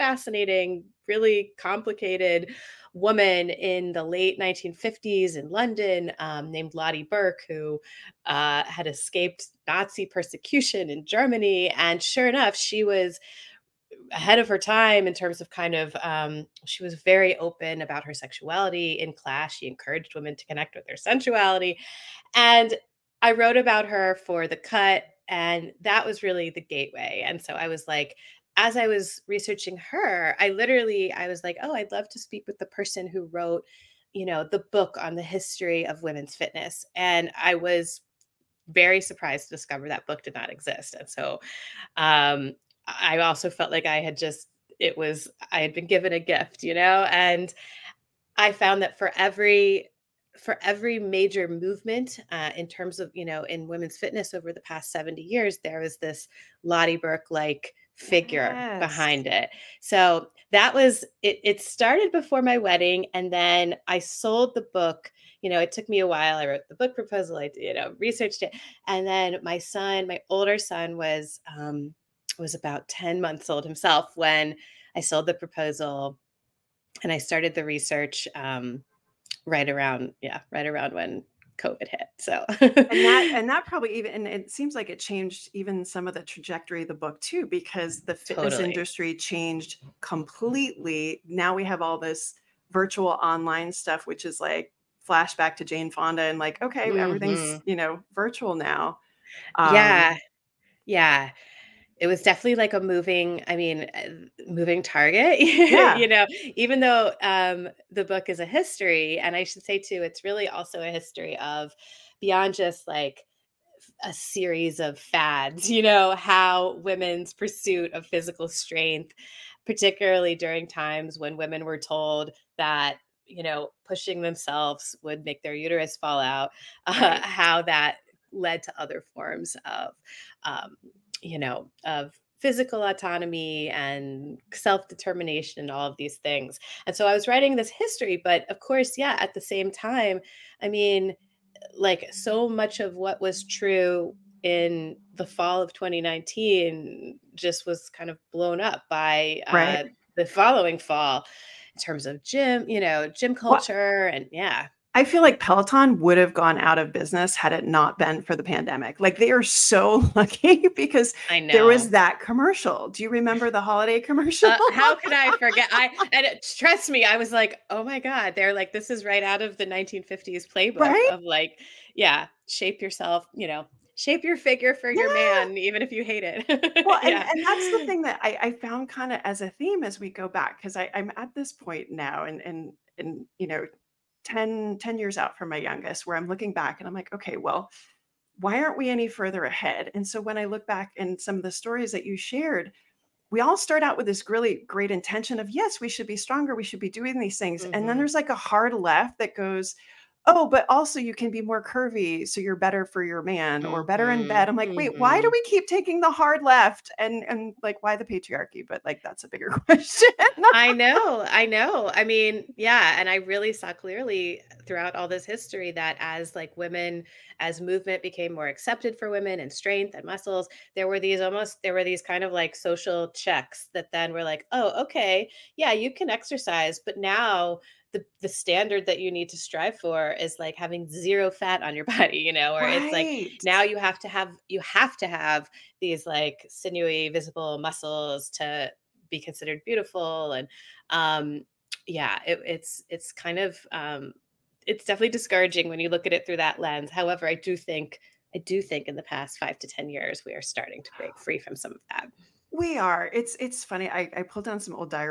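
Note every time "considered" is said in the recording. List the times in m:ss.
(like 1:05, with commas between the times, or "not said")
3:59.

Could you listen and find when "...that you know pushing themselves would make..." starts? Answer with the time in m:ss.
2:02.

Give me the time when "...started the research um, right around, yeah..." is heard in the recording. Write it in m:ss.
1:17.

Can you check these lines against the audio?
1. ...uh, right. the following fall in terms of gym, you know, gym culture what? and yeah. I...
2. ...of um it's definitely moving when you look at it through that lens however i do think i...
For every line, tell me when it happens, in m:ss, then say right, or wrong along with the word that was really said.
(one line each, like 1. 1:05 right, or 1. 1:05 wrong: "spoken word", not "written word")
1. 2:29 right
2. 4:03 wrong: "discouraging", not "moving".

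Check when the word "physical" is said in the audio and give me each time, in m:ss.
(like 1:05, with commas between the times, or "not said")
1:58, 2:12.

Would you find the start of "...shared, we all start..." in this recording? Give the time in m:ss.
3:12.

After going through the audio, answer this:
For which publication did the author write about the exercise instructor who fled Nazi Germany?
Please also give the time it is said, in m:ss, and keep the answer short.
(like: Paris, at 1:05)
The Cut, at 0:24.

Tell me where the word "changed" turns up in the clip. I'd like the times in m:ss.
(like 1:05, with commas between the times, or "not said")
1:24, 1:29.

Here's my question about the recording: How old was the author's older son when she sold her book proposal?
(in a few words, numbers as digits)
10 months.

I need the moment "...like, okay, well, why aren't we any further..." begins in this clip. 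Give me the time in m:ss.
3:06.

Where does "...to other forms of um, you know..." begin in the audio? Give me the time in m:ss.
2:08.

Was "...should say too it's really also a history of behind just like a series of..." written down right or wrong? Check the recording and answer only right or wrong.
wrong.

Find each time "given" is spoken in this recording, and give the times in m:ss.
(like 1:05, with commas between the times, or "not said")
0:45.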